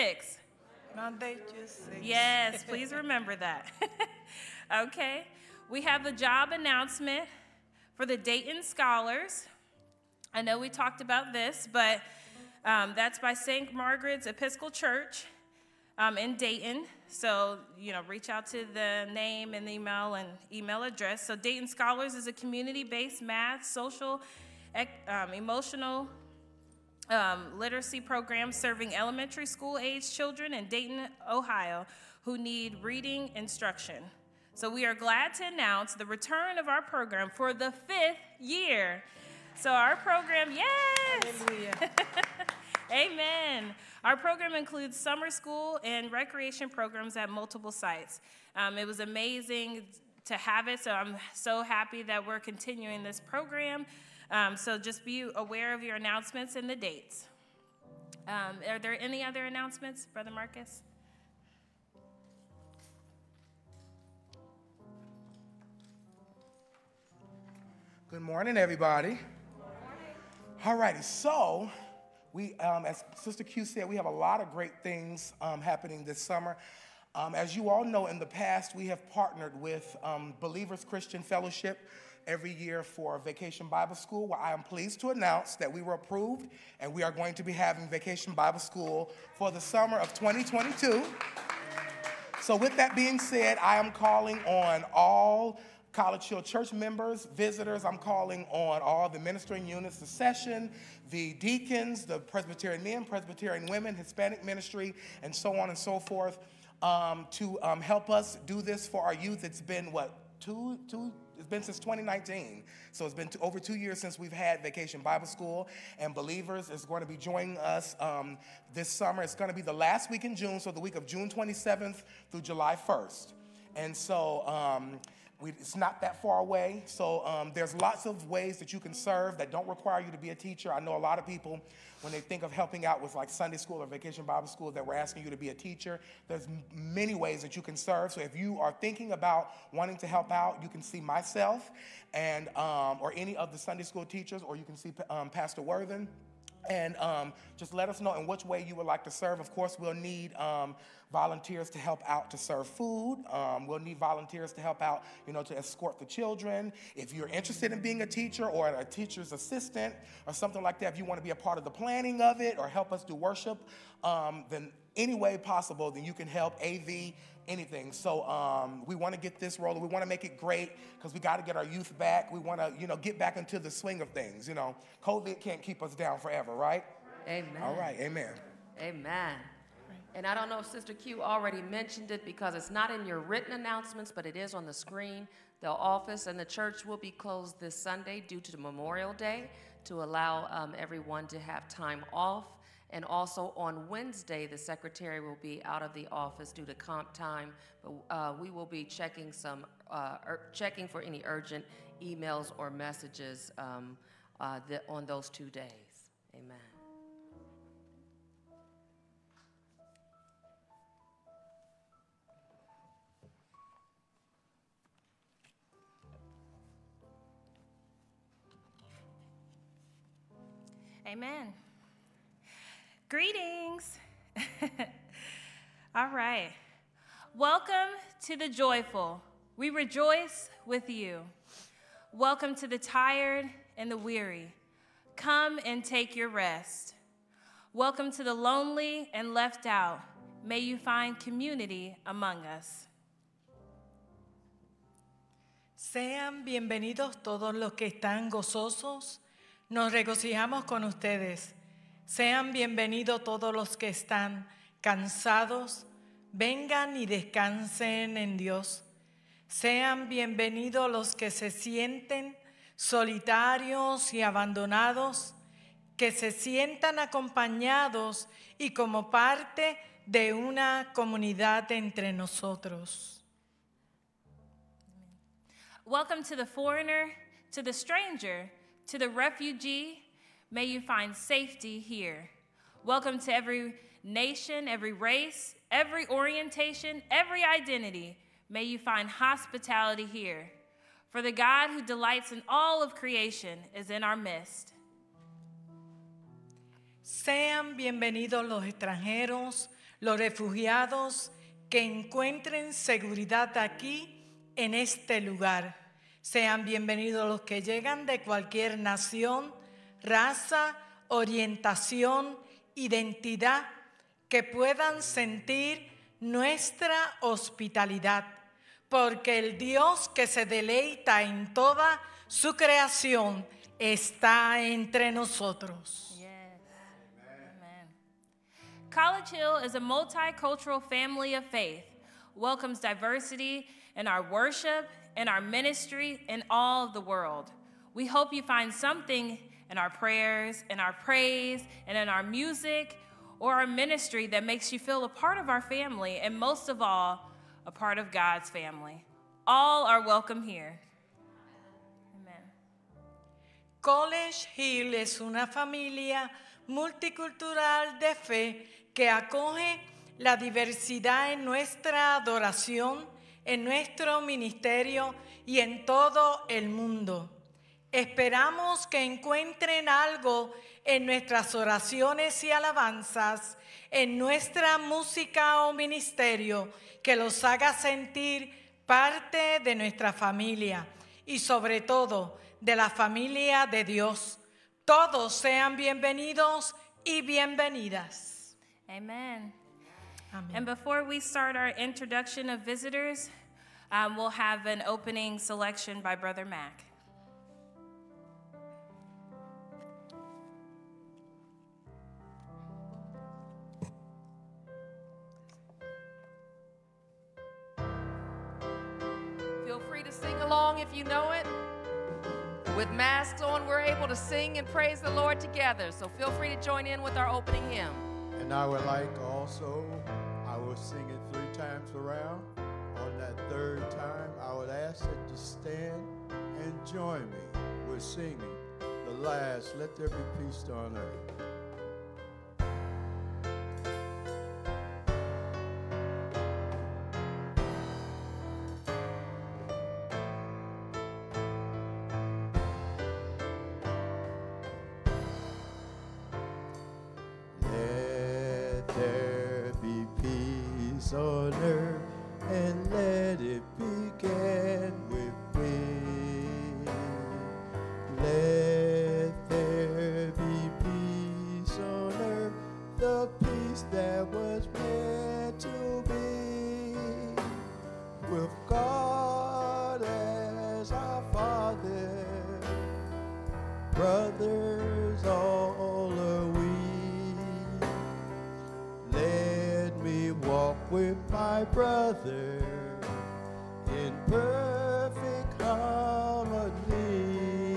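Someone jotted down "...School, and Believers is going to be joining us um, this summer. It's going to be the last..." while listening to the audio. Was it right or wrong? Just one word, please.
right.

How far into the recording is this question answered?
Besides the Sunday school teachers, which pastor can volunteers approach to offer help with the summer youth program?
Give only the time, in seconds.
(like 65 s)
145 s.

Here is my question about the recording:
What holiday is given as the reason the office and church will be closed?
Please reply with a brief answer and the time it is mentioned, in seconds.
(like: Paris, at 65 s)
Memorial Day, at 188 s.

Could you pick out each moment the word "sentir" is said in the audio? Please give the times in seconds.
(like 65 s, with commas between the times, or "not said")
315 s, 377 s.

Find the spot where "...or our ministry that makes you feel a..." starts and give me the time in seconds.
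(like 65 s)
343 s.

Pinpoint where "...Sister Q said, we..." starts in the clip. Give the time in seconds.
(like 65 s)
73 s.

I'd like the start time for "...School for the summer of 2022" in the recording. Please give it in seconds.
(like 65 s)
88 s.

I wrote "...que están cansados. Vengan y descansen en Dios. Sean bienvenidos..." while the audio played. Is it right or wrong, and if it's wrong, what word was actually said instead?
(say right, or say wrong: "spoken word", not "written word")
right.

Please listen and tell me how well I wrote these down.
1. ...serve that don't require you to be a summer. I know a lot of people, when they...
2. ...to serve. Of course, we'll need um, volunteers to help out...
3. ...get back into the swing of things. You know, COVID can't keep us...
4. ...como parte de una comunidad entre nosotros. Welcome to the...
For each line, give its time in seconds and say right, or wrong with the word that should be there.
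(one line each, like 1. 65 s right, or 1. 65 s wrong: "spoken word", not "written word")
1. 128 s wrong: "teacher", not "summer"
2. 149 s right
3. 172 s right
4. 268 s right.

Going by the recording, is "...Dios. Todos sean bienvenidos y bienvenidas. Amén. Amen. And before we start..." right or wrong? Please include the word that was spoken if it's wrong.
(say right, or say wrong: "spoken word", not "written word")
right.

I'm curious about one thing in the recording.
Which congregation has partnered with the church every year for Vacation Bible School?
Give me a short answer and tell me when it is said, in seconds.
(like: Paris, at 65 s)
Believers Christian Fellowship, at 80 s.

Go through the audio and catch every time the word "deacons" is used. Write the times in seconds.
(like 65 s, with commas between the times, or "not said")
101 s.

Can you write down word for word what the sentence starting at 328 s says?
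College Hill is a multicultural family of faith, welcomes diversity in our worship, in our ministry, in all the world.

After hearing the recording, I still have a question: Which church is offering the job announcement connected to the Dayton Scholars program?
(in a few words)
St. Margaret's Episcopal Church.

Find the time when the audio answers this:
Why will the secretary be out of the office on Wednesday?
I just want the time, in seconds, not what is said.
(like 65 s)
196 s.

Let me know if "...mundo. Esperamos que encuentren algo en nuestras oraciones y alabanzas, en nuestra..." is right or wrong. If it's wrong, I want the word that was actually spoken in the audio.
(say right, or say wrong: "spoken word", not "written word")
right.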